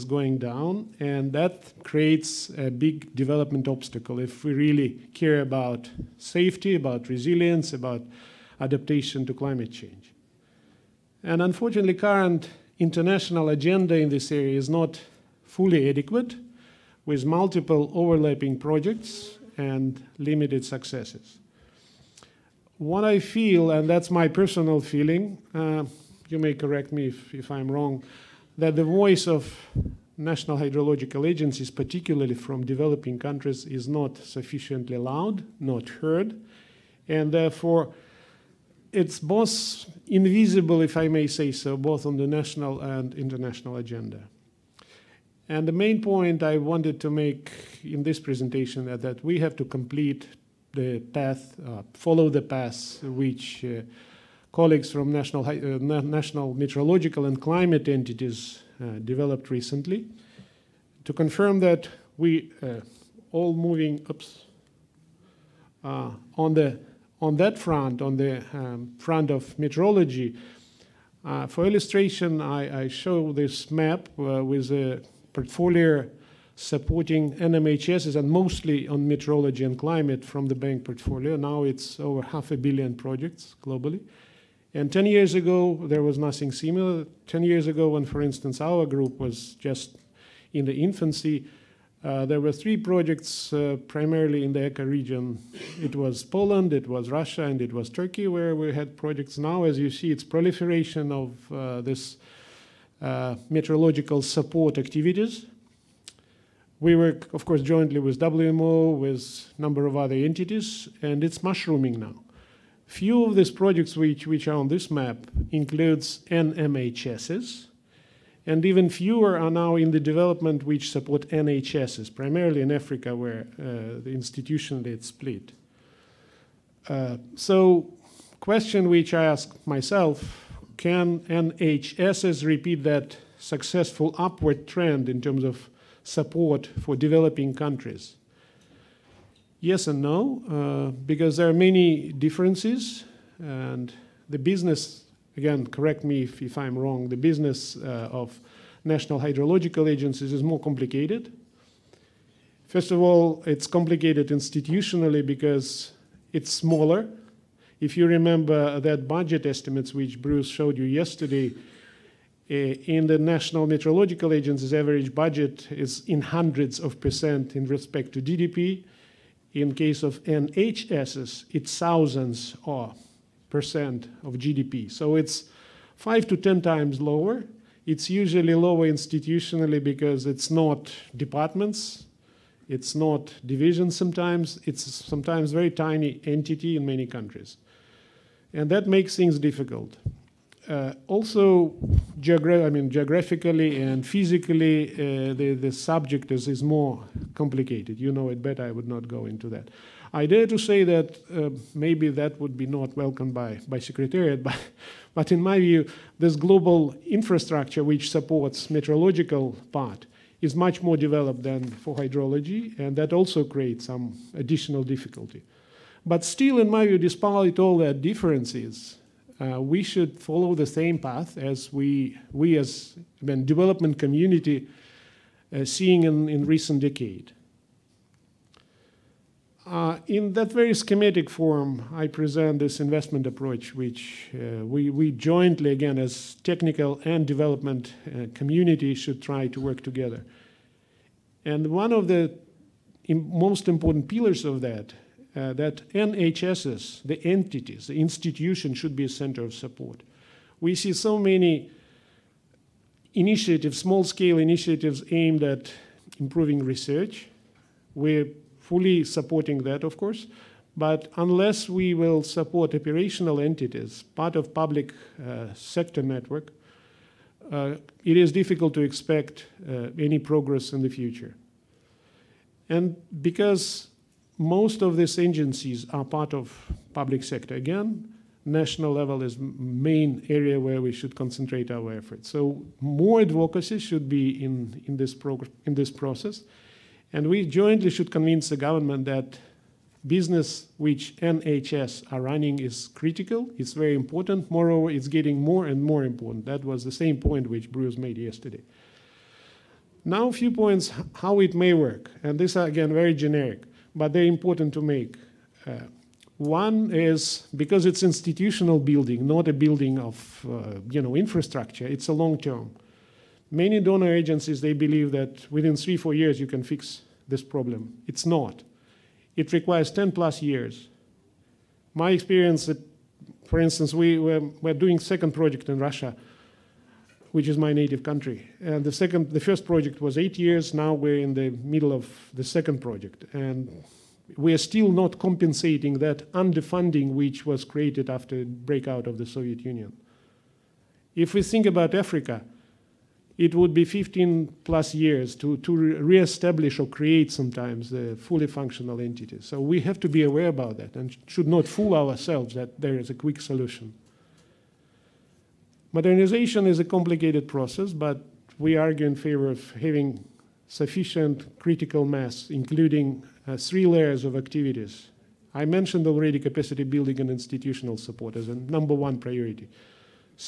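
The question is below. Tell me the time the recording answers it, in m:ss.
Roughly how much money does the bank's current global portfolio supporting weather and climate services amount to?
1:21.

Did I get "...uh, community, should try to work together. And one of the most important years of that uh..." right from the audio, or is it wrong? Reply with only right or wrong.
wrong.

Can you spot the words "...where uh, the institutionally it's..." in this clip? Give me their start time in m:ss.
2:03.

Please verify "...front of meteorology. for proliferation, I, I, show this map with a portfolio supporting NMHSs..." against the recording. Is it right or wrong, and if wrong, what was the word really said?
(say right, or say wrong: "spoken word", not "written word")
wrong: "illustration", not "proliferation".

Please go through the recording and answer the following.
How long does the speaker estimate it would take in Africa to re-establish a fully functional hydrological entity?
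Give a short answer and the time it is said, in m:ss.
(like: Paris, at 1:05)
15 plus years, at 5:43.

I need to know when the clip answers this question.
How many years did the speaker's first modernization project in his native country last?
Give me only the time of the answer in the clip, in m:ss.
5:30.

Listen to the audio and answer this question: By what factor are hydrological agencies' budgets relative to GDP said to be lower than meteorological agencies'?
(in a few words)
5 to 10 times.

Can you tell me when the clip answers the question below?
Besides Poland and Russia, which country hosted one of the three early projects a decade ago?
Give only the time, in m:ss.
1:37.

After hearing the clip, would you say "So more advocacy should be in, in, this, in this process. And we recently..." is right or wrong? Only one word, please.
wrong.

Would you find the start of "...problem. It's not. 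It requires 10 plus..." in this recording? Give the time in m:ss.
5:17.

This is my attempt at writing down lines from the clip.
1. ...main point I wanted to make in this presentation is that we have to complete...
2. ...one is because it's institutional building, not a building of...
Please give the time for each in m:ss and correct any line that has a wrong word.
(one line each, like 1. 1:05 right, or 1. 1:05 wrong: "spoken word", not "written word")
1. 0:45 right
2. 5:06 right.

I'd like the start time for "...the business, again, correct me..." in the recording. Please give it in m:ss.
2:24.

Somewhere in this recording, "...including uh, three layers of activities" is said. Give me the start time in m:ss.
6:02.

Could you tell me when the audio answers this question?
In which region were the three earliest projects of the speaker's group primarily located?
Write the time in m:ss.
1:34.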